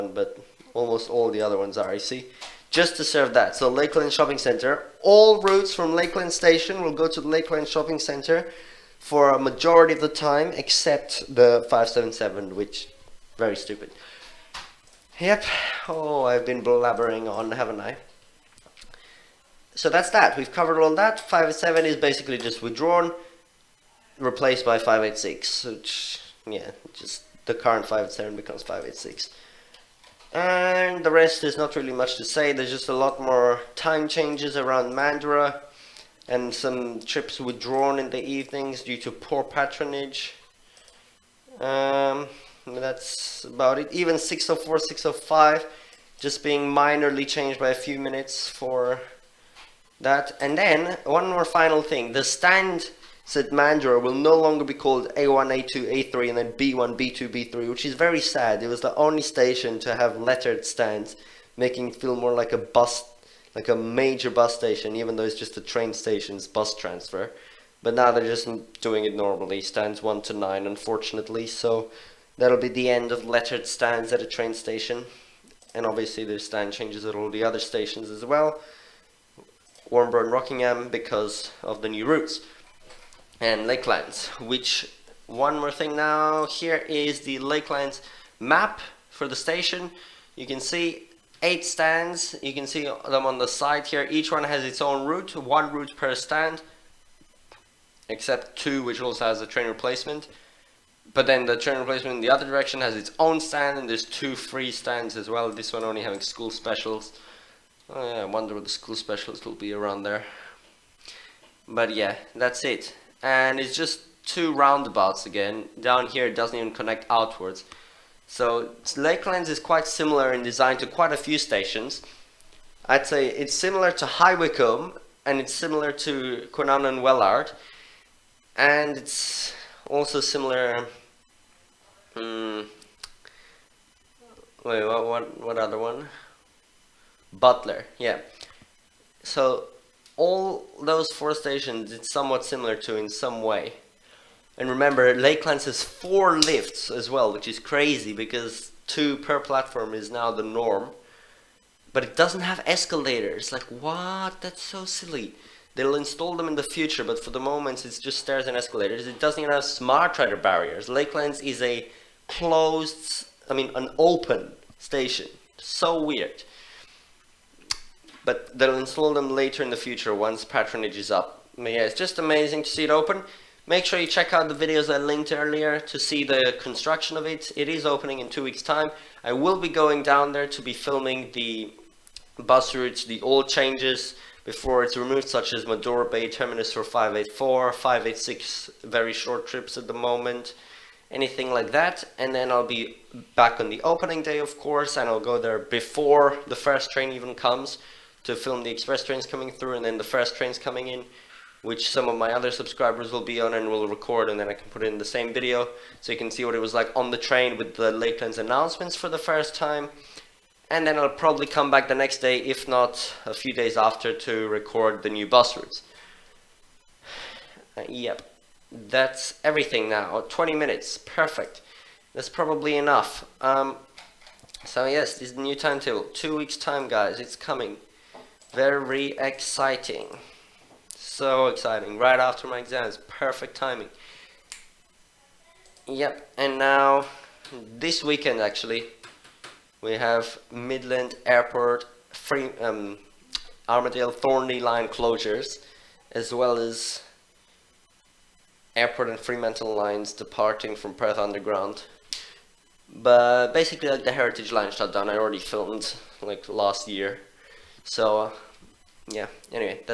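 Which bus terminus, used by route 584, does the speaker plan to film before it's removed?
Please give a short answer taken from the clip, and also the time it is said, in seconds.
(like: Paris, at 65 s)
Madora Bay, at 185 s.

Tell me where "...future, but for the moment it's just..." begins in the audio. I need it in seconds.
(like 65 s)
156 s.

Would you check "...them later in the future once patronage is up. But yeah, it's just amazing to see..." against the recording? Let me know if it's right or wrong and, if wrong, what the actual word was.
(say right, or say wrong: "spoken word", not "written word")
right.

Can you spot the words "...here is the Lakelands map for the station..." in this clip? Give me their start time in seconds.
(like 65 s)
86 s.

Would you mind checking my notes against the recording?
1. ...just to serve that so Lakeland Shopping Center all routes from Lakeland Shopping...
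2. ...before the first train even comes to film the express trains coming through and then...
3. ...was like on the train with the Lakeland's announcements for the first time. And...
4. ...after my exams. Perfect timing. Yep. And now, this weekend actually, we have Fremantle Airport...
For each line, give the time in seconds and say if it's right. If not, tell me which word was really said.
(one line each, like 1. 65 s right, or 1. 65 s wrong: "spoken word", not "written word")
1. 2 s wrong: "Station", not "Shopping"
2. 195 s right
3. 206 s right
4. 232 s wrong: "Midland", not "Fremantle".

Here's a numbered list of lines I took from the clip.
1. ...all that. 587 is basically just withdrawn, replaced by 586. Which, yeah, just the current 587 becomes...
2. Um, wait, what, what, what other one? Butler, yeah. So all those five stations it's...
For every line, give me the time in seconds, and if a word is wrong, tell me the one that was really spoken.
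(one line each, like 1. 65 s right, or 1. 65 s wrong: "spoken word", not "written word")
1. 20 s right
2. 132 s wrong: "four", not "five".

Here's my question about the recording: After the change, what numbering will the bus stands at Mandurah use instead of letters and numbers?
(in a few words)
1 to 9.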